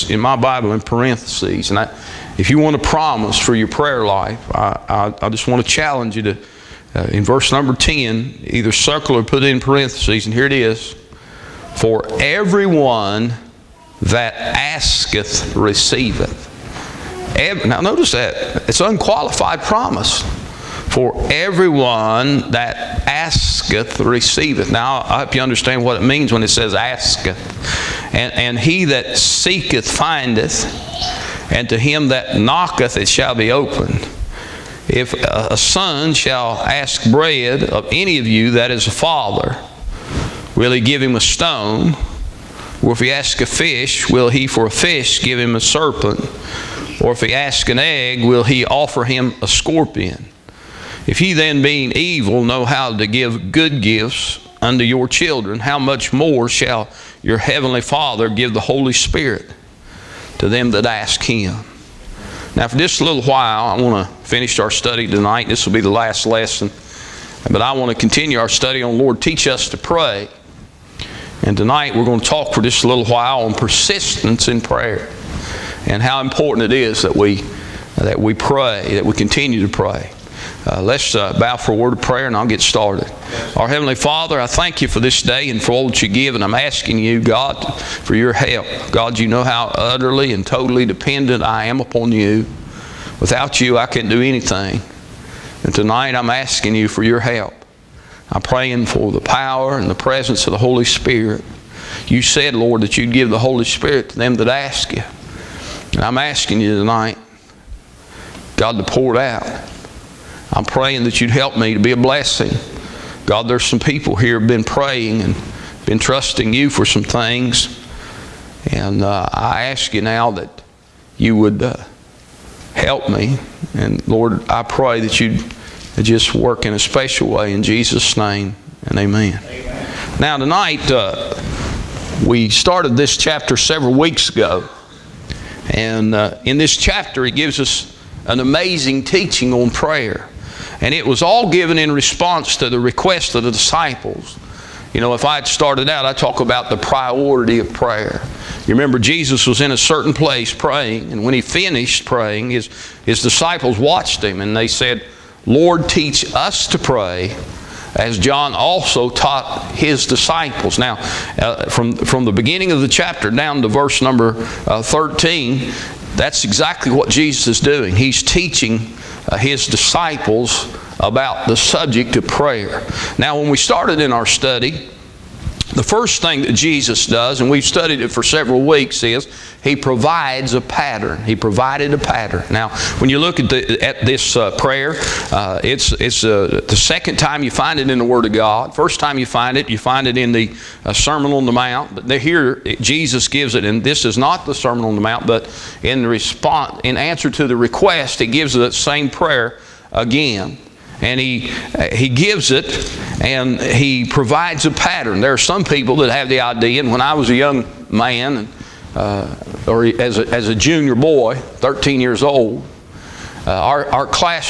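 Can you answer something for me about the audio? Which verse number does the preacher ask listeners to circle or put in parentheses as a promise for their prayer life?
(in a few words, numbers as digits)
10.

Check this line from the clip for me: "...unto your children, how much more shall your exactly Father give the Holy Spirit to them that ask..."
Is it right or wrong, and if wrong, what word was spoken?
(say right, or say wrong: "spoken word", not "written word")
wrong: "heavenly", not "exactly".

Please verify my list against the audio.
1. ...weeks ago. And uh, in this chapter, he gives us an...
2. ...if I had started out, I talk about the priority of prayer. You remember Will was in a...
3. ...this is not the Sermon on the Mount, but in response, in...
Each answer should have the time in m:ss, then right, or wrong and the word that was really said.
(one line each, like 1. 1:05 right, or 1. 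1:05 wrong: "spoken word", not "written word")
1. 2:13 right
2. 2:25 wrong: "Jesus", not "Will"
3. 3:13 right.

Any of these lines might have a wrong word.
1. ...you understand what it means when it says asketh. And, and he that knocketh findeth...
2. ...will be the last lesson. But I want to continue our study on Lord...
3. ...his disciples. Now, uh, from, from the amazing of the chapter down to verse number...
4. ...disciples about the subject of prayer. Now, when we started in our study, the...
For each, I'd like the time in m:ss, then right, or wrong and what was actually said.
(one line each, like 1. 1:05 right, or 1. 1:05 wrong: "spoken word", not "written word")
1. 0:25 wrong: "seeketh", not "knocketh"
2. 1:05 right
3. 2:39 wrong: "beginning", not "amazing"
4. 2:49 right.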